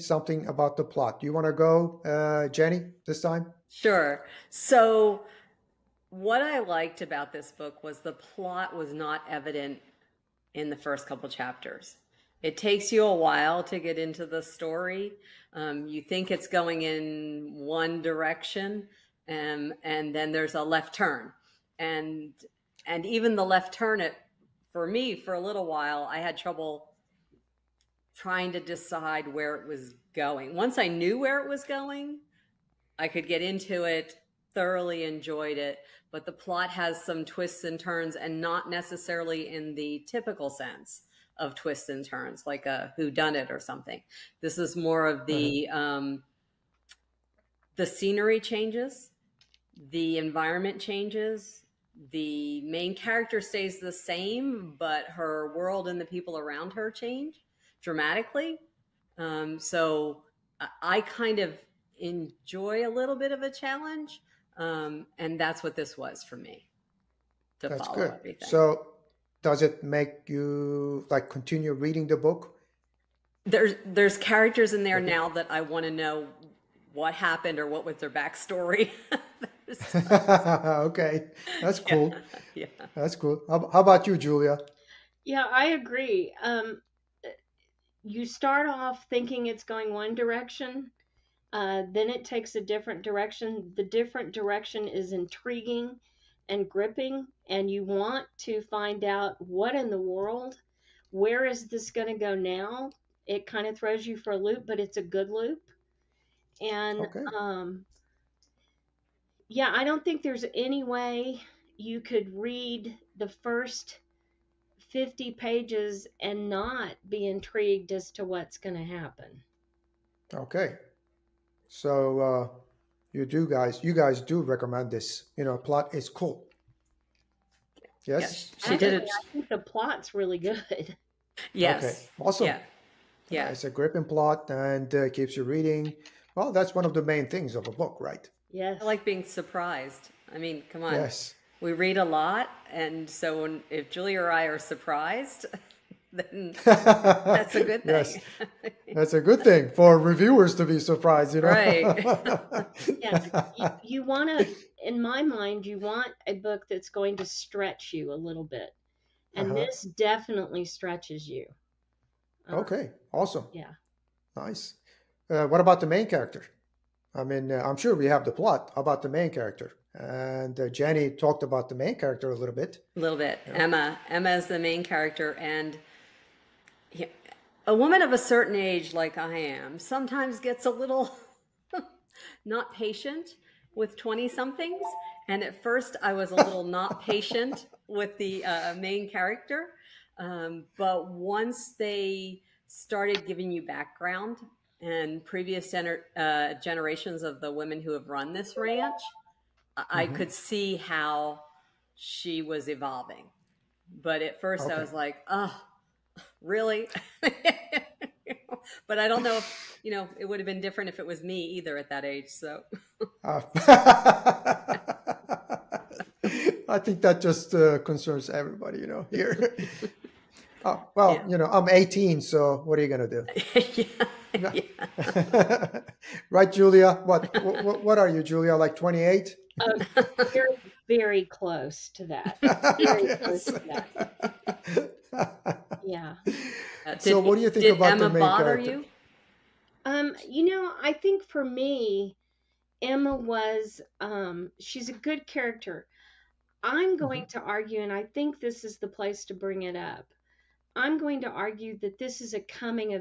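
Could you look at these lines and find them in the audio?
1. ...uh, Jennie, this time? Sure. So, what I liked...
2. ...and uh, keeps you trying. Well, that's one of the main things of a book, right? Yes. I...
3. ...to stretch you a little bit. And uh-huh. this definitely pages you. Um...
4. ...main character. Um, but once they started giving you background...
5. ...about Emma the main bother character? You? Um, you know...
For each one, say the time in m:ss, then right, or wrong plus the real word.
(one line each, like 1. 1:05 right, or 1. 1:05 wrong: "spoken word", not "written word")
1. 0:02 right
2. 2:14 wrong: "reading", not "trying"
3. 2:37 wrong: "stretches", not "pages"
4. 3:08 right
5. 3:57 right.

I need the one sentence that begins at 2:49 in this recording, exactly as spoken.
And uh, Jennie talked about the main character a little bit.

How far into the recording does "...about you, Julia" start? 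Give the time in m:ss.
1:23.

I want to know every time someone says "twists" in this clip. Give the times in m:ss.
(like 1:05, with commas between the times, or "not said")
0:37, 0:41.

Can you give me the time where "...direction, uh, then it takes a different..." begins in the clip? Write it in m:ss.
1:30.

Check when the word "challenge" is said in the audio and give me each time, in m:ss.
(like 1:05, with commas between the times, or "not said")
1:03.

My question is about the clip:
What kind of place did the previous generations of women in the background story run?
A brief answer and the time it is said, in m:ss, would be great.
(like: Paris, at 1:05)
ranch, at 3:18.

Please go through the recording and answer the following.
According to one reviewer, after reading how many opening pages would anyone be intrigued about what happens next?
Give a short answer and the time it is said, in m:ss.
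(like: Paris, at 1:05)
50, at 1:54.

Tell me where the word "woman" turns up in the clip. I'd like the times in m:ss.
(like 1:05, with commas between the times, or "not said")
2:57.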